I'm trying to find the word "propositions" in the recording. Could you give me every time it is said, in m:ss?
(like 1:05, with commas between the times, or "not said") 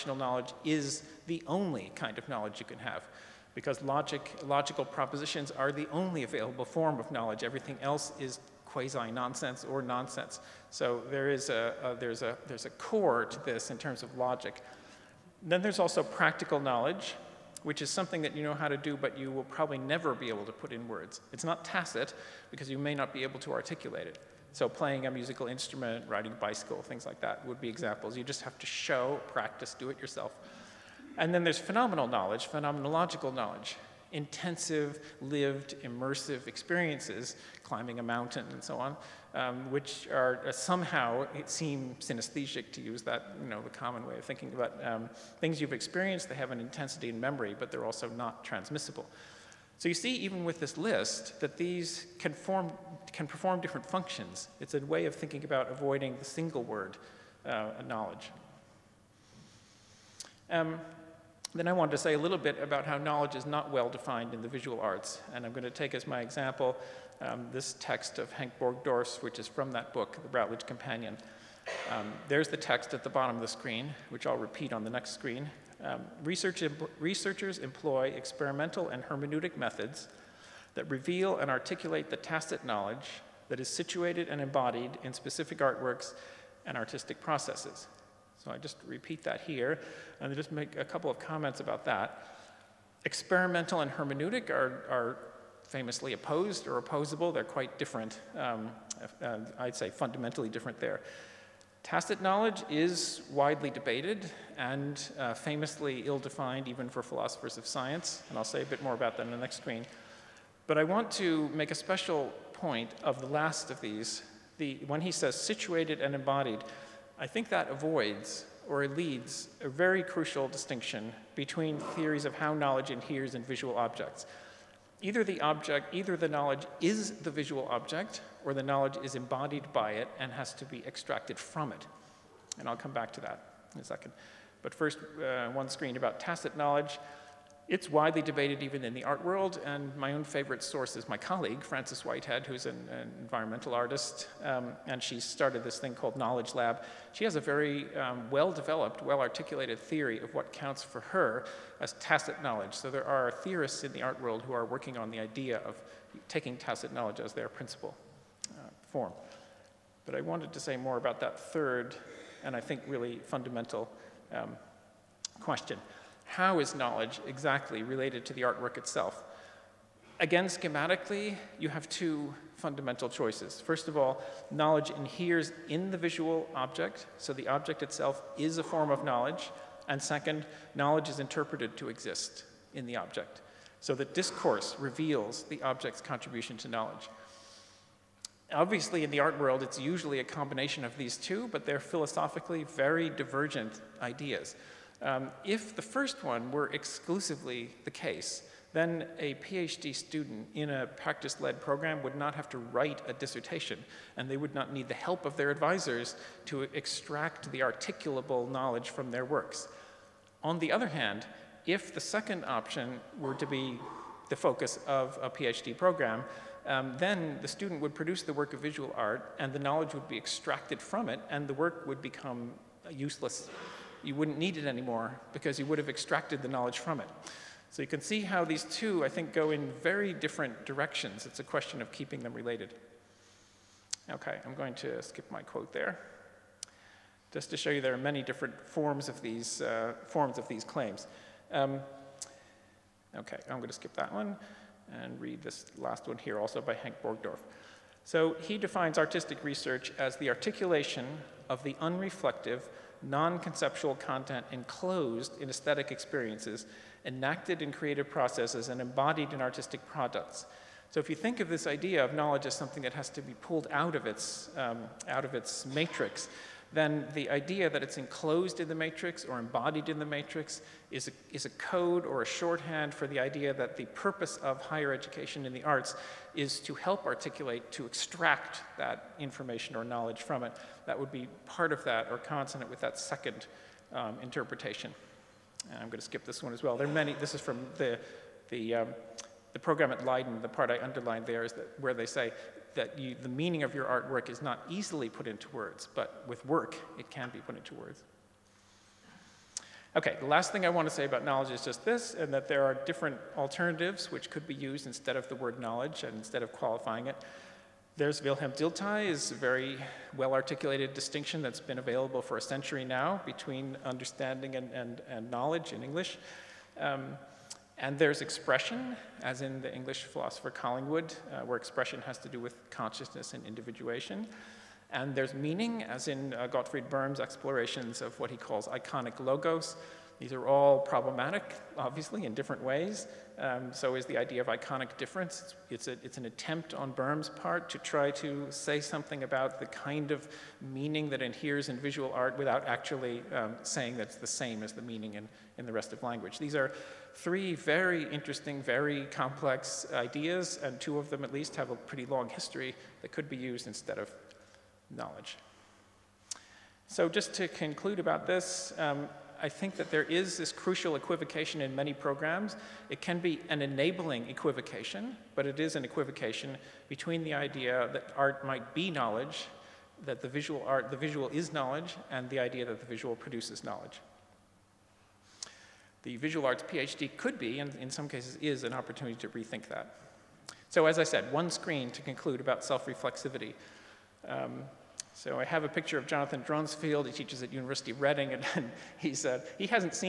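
0:04.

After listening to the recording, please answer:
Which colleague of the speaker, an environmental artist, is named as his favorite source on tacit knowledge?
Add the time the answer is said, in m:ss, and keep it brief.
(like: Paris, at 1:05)
Frances Whitehead, at 2:21.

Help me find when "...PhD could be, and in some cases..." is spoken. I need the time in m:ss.
6:16.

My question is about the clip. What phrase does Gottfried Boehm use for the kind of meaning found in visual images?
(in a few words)
iconic logos.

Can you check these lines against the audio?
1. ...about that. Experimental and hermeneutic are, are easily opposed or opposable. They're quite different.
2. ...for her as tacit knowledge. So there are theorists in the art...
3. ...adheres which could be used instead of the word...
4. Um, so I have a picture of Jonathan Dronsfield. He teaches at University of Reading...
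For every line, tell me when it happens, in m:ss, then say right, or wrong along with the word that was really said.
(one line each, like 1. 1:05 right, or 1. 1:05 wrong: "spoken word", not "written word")
1. 1:31 wrong: "famously", not "easily"
2. 2:30 right
3. 5:03 wrong: "alternatives", not "adheres"
4. 6:24 right.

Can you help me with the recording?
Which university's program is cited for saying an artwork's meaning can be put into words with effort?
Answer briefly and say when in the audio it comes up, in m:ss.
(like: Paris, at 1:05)
Leiden, at 4:50.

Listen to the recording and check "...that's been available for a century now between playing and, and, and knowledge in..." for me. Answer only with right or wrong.
wrong.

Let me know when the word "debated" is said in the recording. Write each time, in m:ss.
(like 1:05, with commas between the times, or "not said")
1:43, 2:18.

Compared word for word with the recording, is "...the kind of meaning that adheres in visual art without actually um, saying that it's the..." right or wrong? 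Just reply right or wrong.
right.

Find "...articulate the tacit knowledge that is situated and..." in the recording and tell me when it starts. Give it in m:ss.
1:21.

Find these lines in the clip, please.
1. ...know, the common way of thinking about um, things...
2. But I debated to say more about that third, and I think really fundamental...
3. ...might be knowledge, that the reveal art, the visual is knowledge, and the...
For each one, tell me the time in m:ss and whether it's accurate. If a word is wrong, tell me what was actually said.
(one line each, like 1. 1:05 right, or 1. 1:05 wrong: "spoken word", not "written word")
1. 0:43 right
2. 2:40 wrong: "wanted", not "debated"
3. 6:08 wrong: "visual", not "reveal".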